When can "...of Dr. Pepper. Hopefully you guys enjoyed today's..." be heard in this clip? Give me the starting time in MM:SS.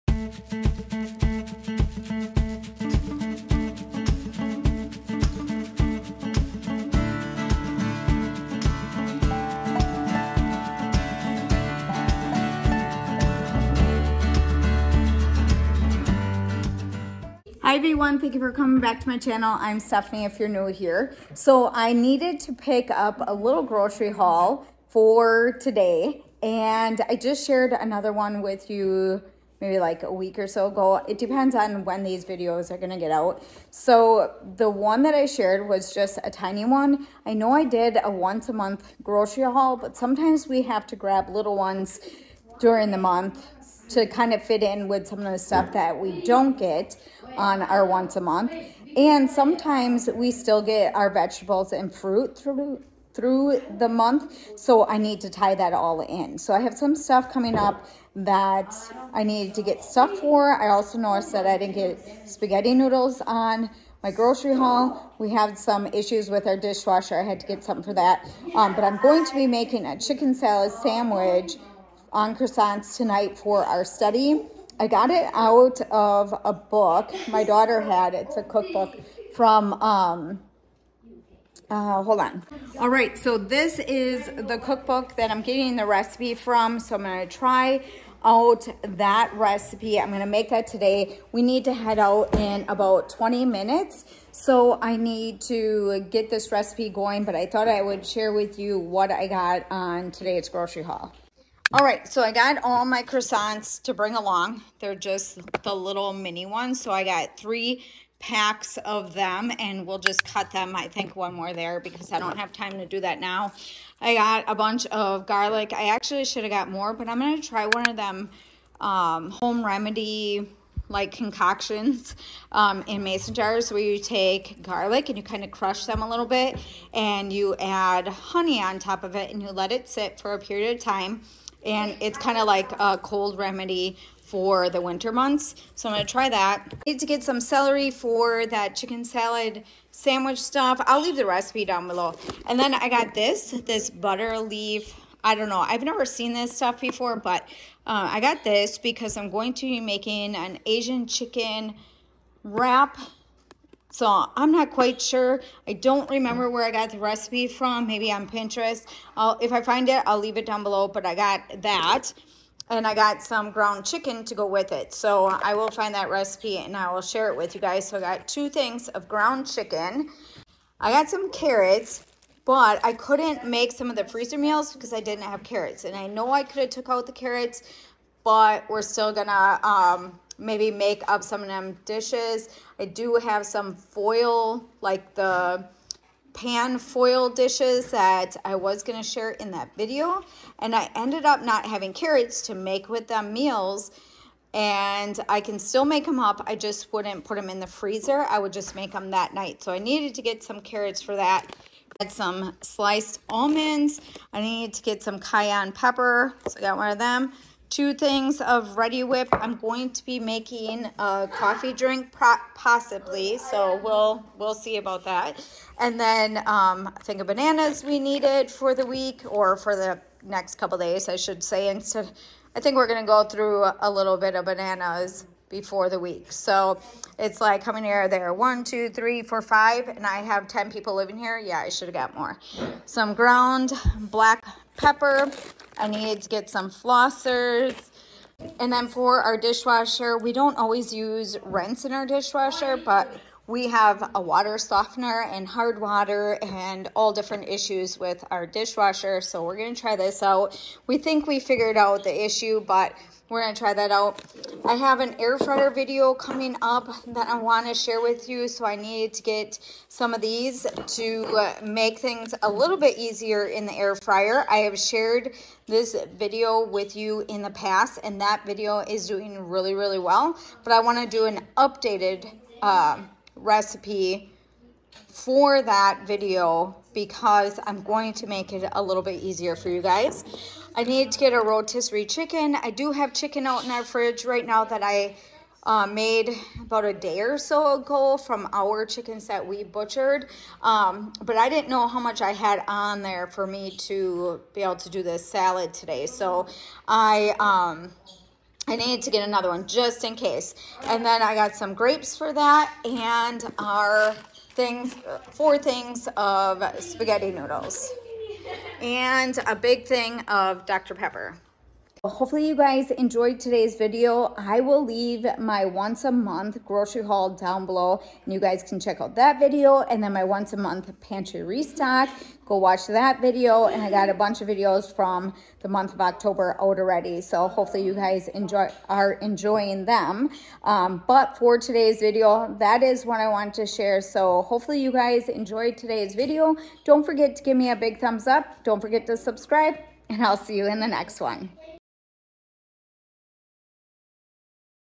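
05:10.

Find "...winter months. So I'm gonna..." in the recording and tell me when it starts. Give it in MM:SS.
02:14.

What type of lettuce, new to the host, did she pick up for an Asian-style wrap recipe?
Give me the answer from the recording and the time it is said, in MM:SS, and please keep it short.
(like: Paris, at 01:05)
butter leaf, at 02:23.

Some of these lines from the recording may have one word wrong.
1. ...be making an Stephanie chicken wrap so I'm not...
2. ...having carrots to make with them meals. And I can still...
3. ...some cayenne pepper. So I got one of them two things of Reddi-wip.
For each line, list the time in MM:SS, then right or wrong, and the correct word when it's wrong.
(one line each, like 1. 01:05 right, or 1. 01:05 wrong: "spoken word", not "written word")
1. 02:29 wrong: "Asian", not "Stephanie"
2. 03:11 right
3. 03:25 right.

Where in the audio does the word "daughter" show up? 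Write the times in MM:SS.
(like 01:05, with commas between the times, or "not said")
01:17.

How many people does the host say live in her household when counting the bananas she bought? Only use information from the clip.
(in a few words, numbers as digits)
10.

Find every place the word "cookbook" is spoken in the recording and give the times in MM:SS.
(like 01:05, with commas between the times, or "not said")
01:18, 01:24.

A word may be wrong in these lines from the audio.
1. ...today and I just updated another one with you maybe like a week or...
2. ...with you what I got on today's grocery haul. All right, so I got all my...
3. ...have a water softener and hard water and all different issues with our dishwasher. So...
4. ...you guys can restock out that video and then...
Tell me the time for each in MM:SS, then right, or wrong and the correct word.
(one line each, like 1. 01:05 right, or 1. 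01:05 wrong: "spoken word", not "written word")
1. 00:25 wrong: "shared", not "updated"
2. 01:38 right
3. 04:03 right
4. 05:18 wrong: "check", not "restock".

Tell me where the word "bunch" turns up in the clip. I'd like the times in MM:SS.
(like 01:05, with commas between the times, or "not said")
01:54, 05:24.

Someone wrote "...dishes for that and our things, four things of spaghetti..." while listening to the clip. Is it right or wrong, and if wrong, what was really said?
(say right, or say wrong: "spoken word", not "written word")
wrong: "grapes", not "dishes".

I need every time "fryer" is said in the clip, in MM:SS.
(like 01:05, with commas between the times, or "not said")
04:15, 04:23.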